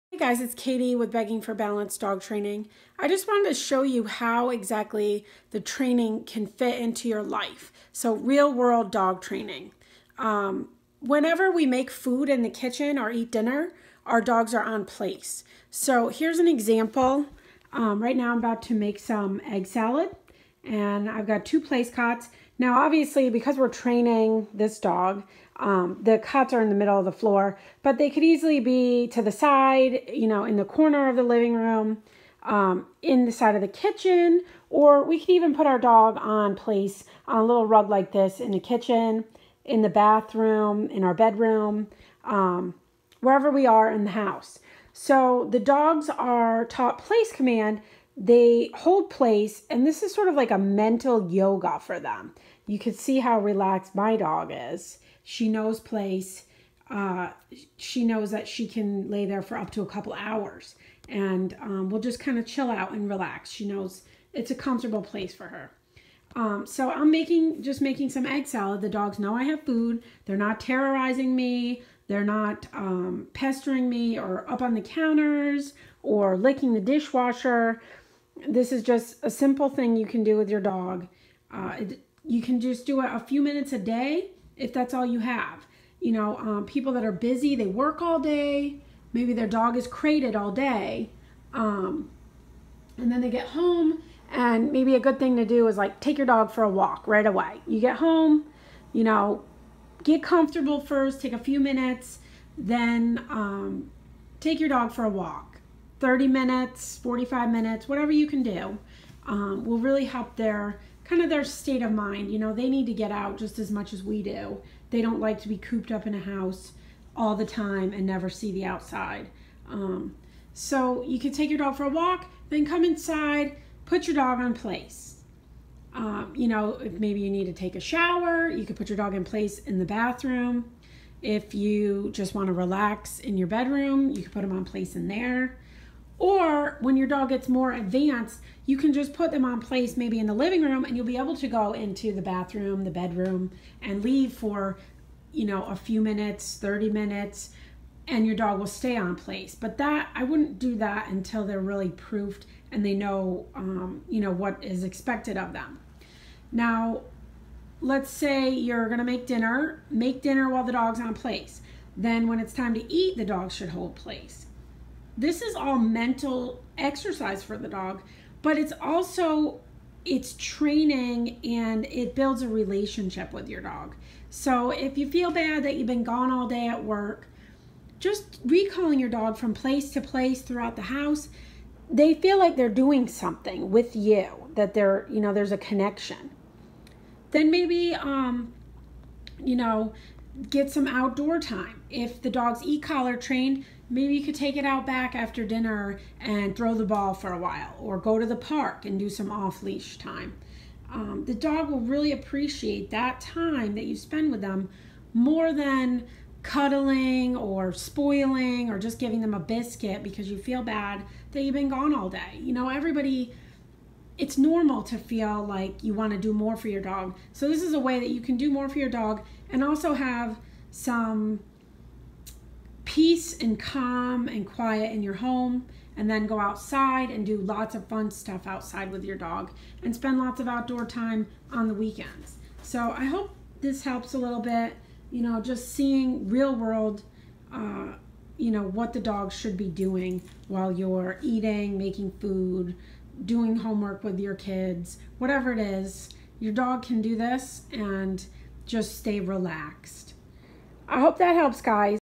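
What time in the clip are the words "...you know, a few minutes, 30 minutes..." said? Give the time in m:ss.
2:25.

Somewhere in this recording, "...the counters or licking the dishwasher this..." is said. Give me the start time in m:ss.
1:14.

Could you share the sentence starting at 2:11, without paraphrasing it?
If you just want to relax in your bedroom, you can put them on place in there.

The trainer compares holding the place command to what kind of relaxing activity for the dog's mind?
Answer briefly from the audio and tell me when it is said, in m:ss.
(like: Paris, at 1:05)
Mental yoga, at 0:50.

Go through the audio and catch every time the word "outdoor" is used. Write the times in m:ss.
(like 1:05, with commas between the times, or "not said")
3:10, 3:50.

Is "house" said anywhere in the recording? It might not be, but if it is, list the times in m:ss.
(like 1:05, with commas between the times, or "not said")
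0:44, 1:56, 3:00.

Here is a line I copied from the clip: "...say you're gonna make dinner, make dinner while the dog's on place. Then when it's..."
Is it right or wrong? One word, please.
right.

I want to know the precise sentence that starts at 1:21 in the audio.
Uh, it, you can just do it a few minutes a day if that's all you have.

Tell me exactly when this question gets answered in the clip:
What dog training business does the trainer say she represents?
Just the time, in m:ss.
0:01.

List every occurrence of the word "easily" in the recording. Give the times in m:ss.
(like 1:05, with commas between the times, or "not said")
0:28.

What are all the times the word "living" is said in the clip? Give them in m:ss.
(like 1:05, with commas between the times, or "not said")
0:31, 2:20.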